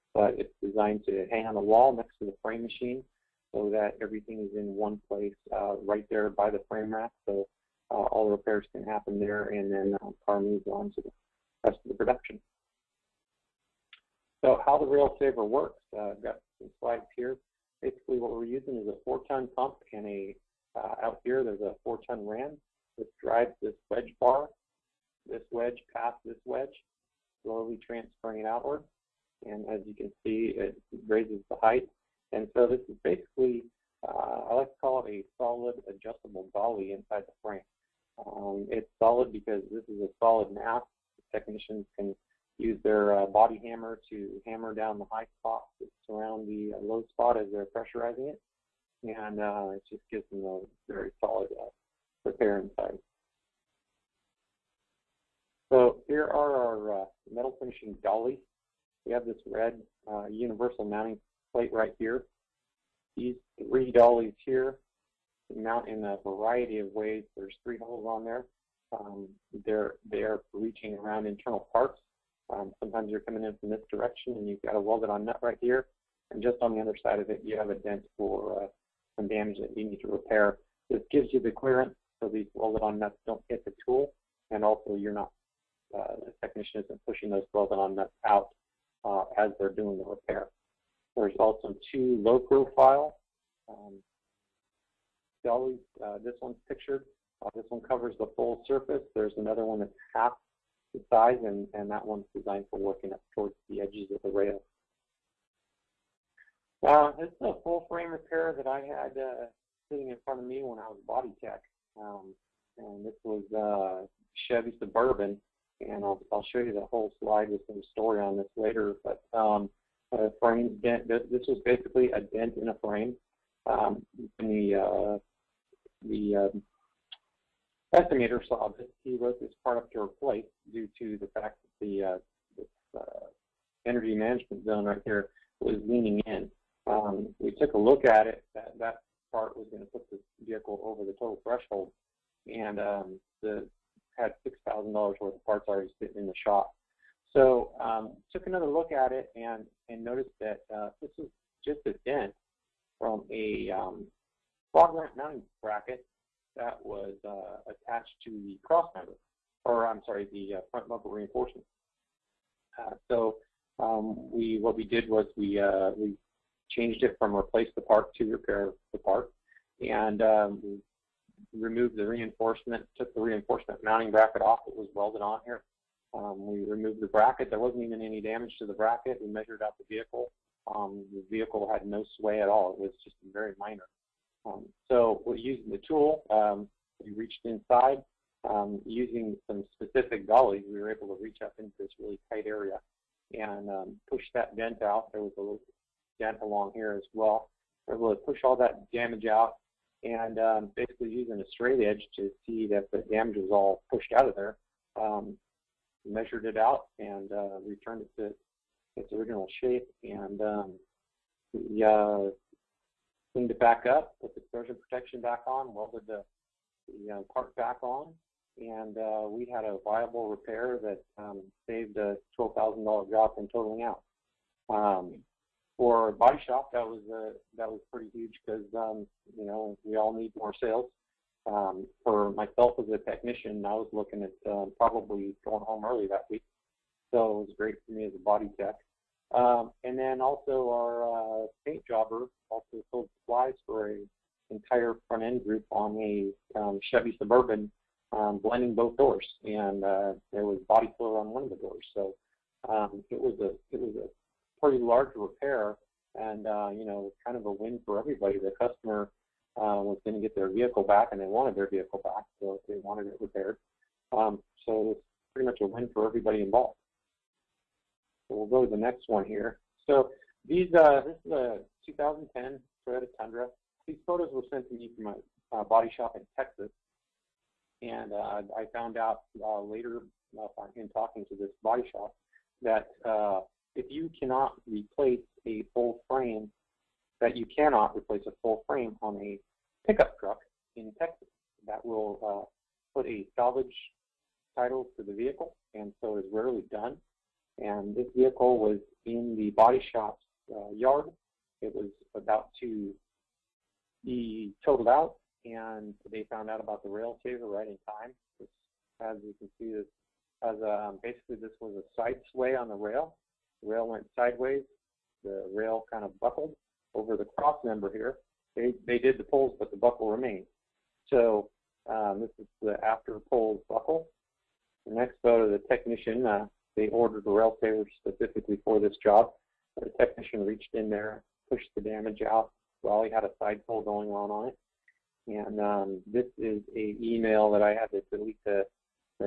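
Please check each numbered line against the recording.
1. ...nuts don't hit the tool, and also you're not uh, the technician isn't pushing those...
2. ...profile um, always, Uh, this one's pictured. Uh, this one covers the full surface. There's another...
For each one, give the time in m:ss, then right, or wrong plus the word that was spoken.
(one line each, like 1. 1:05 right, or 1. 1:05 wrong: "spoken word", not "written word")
1. 1:22 right
2. 1:32 right.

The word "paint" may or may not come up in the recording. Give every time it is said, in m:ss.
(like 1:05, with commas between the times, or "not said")
4:01.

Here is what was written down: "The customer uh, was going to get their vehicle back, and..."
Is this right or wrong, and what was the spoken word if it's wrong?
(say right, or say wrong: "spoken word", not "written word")
right.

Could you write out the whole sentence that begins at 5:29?
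The technician reached in there, pushed the damage out.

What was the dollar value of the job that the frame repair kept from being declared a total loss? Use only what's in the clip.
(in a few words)
$12,000.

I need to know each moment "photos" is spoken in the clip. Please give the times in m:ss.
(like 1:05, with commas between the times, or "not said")
4:34, 5:25.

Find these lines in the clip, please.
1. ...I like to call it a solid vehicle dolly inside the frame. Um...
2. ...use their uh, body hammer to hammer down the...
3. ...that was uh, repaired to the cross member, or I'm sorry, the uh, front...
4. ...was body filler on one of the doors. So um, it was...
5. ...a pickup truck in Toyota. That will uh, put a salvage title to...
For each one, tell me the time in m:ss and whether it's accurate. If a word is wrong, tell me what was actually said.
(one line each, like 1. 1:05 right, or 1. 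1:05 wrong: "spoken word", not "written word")
1. 0:34 wrong: "adjustable", not "vehicle"
2. 0:42 right
3. 2:36 wrong: "attached", not "repaired"
4. 4:10 right
5. 4:49 wrong: "Texas", not "Toyota".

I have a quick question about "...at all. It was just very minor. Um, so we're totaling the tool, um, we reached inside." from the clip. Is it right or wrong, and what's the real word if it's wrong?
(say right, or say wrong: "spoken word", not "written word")
wrong: "using", not "totaling".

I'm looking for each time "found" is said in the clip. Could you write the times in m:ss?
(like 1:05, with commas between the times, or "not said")
4:38, 5:06.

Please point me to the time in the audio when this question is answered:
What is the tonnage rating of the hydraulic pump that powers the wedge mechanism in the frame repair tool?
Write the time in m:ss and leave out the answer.
0:19.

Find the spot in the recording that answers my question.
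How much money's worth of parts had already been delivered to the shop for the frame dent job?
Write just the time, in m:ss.
2:24.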